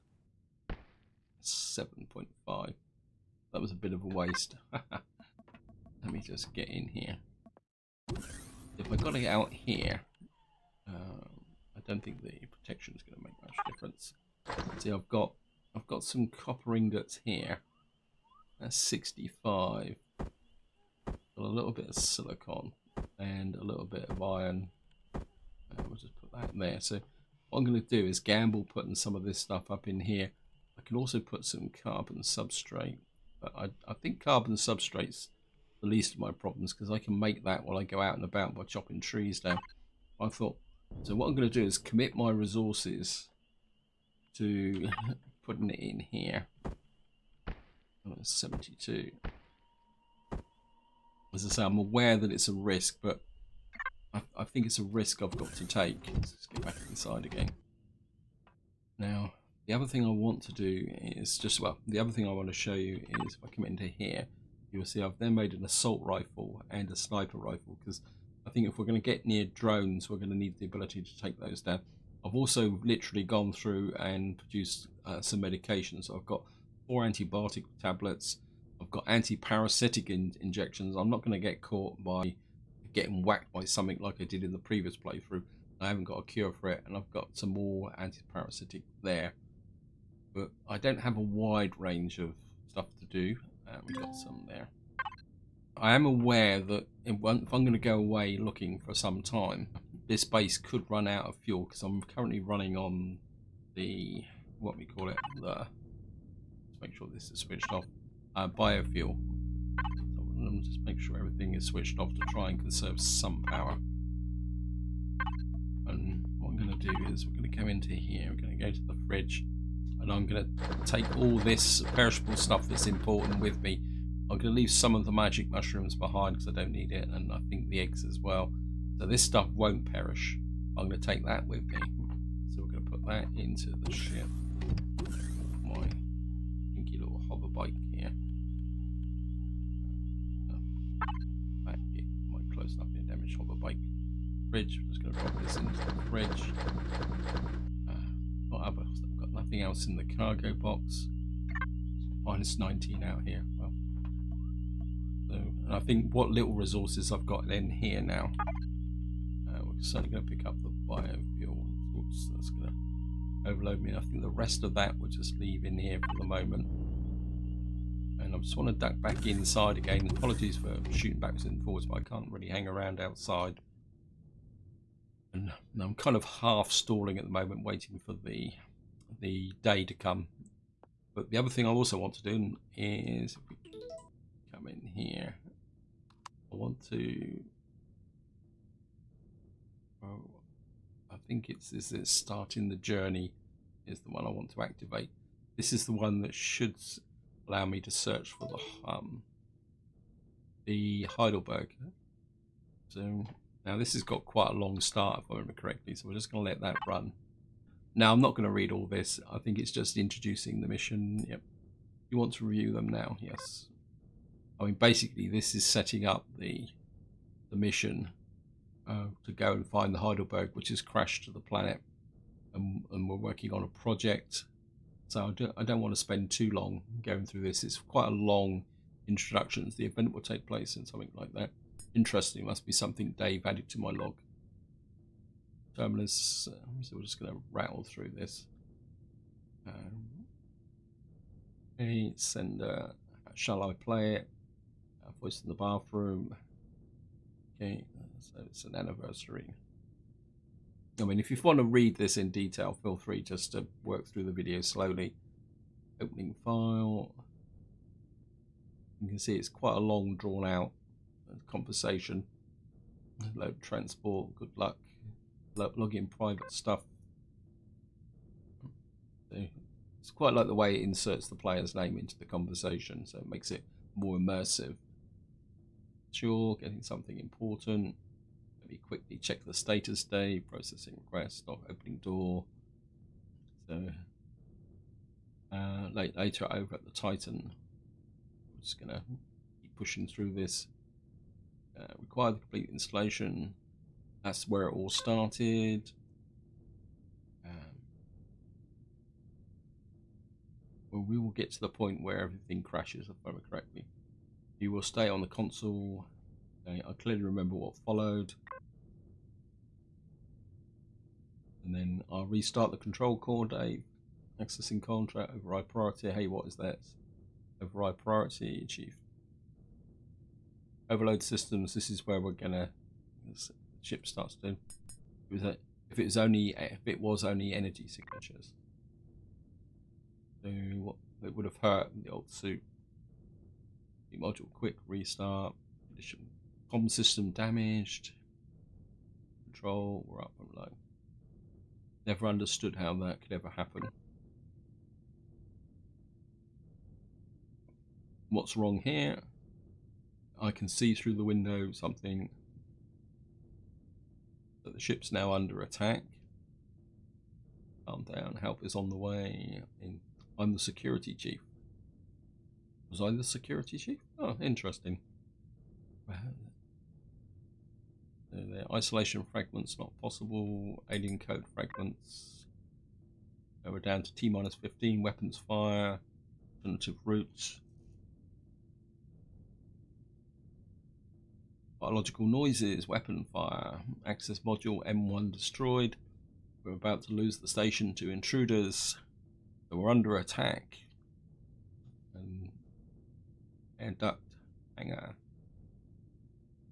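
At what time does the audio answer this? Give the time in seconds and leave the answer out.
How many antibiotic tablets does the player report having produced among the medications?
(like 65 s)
76 s.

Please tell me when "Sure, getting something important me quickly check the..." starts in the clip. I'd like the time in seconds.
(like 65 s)
276 s.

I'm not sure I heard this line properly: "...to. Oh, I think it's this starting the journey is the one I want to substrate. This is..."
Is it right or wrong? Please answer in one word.
wrong.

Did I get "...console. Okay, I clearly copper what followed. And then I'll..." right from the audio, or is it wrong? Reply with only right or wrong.
wrong.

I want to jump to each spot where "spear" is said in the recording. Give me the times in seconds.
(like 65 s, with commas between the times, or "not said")
not said.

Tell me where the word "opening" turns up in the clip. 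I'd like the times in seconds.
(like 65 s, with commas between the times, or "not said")
255 s, 281 s.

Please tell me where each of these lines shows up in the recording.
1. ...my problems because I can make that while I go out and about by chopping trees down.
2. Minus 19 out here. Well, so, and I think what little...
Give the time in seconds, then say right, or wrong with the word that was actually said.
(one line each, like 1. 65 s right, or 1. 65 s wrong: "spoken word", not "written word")
1. 36 s right
2. 152 s right.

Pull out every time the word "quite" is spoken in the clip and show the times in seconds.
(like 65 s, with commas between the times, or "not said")
204 s, 227 s, 259 s, 270 s.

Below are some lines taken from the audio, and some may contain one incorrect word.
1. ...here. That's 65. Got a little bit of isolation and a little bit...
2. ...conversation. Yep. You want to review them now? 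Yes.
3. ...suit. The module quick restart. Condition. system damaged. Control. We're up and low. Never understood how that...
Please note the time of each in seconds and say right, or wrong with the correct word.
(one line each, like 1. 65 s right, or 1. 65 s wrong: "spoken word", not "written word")
1. 17 s wrong: "silicon", not "isolation"
2. 210 s wrong: "mission", not "conversation"
3. 332 s right.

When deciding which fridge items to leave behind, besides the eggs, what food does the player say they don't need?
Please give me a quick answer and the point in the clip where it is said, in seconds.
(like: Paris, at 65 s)
magic mushrooms, at 125 s.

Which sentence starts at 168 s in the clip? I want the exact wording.
And I just want to duck back inside again.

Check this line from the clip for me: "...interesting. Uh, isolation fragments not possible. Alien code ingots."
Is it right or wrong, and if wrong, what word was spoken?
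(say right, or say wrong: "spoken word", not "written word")
wrong: "fragments", not "ingots".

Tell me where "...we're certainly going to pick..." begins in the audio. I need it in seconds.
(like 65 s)
159 s.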